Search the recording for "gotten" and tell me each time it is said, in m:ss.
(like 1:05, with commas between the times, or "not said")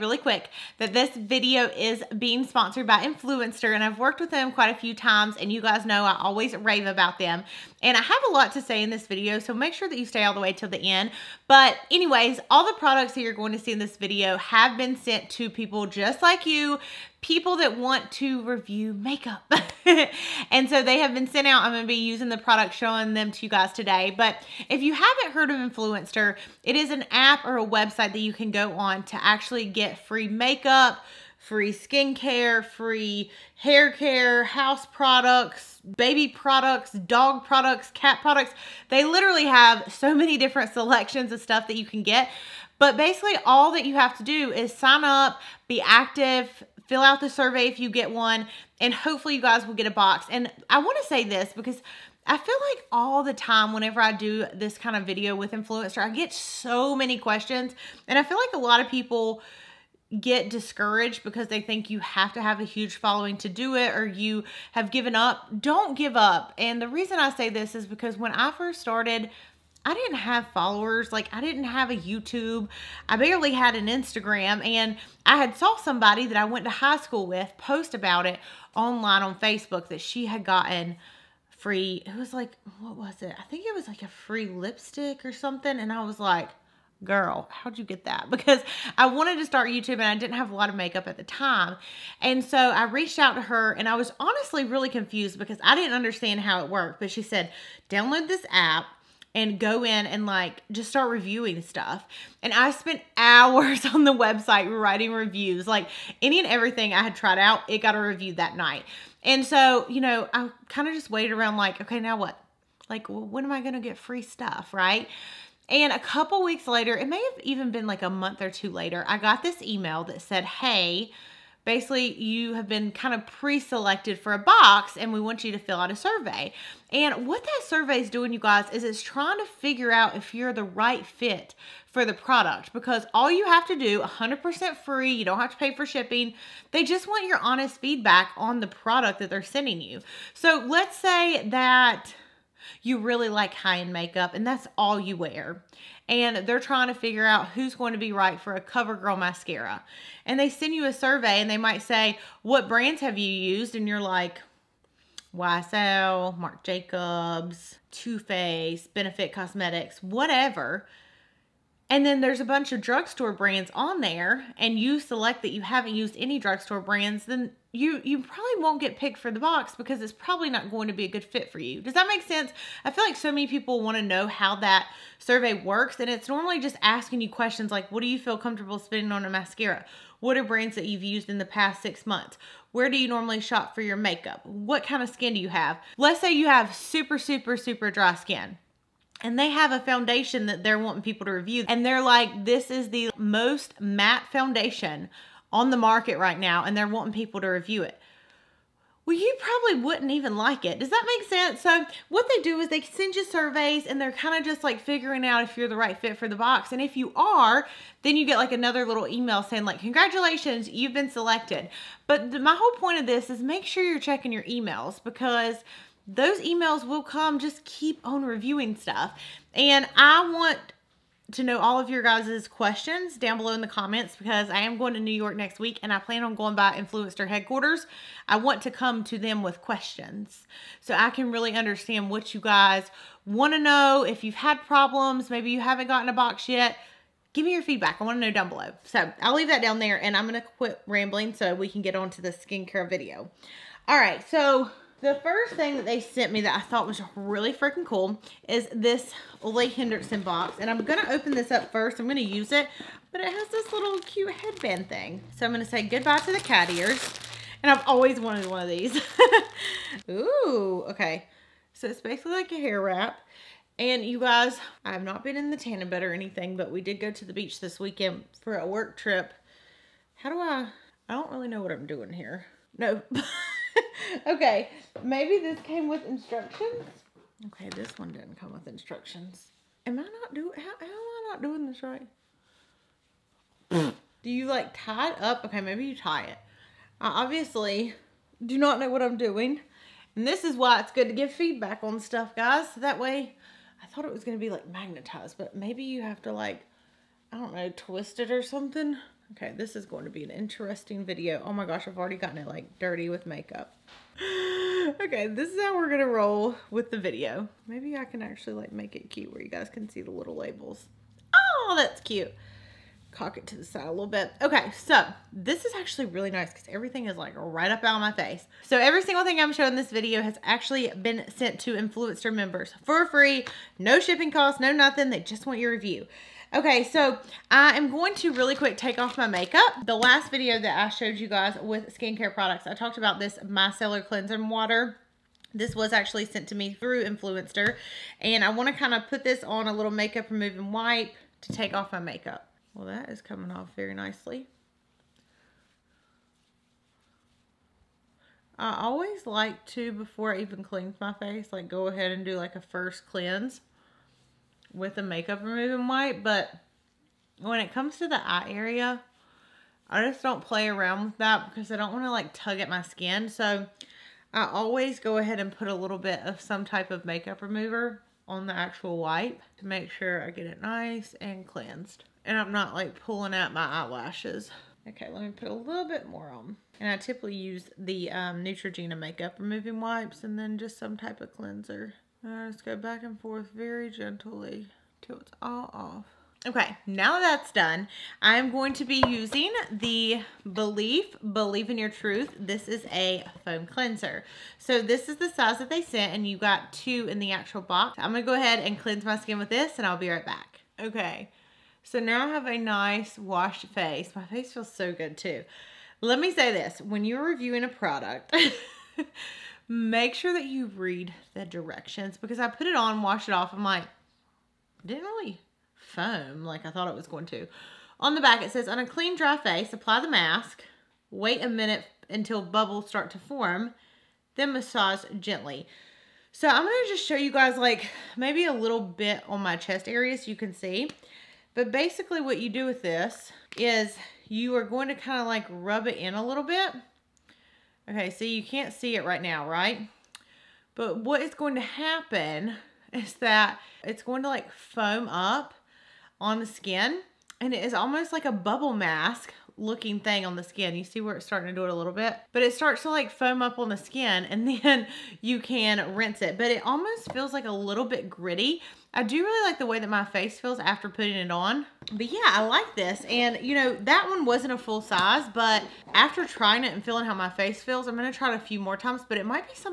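1:20, 3:55, 5:02.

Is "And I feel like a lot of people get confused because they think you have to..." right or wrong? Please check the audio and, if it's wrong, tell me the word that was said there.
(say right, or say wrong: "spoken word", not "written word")
wrong: "discouraged", not "confused".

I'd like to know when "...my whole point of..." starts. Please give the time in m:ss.
3:32.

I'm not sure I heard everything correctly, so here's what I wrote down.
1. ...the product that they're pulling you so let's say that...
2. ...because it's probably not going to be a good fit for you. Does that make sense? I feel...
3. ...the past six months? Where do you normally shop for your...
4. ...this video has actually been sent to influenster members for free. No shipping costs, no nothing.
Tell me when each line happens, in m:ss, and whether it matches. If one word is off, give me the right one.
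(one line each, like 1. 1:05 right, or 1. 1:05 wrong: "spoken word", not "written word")
1. 2:18 wrong: "sending", not "pulling"
2. 2:49 right
3. 3:01 right
4. 5:19 right.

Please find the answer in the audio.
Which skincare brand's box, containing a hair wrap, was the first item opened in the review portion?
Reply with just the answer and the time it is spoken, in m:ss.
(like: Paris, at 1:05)
Ole Henriksen, at 4:09.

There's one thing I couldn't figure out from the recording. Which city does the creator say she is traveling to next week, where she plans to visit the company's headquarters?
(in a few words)
New York.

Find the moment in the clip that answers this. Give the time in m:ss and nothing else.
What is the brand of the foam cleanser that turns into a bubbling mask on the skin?
6:30.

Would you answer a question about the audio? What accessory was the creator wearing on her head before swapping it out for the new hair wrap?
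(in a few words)
cat ears.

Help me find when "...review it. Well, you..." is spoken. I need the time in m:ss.
3:17.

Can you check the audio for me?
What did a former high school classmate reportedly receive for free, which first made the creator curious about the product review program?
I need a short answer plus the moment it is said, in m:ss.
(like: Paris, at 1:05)
lipstick, at 1:24.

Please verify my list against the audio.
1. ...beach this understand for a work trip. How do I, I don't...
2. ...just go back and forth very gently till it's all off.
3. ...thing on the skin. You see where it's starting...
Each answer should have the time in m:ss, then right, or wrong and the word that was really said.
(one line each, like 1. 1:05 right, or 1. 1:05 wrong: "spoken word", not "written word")
1. 4:27 wrong: "weekend", not "understand"
2. 6:22 right
3. 7:29 right.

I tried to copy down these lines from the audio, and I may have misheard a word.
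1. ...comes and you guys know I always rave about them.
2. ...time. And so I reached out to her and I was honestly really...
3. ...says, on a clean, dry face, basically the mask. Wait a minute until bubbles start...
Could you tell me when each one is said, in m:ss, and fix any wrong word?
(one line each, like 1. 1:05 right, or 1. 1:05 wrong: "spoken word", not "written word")
1. 0:04 wrong: "times", not "comes"
2. 1:31 right
3. 6:58 wrong: "apply", not "basically".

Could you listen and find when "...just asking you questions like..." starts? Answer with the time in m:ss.
2:56.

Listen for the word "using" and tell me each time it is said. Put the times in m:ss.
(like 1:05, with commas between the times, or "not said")
0:21, 6:29.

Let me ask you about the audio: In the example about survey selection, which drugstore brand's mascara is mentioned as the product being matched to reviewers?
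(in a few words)
CoverGirl.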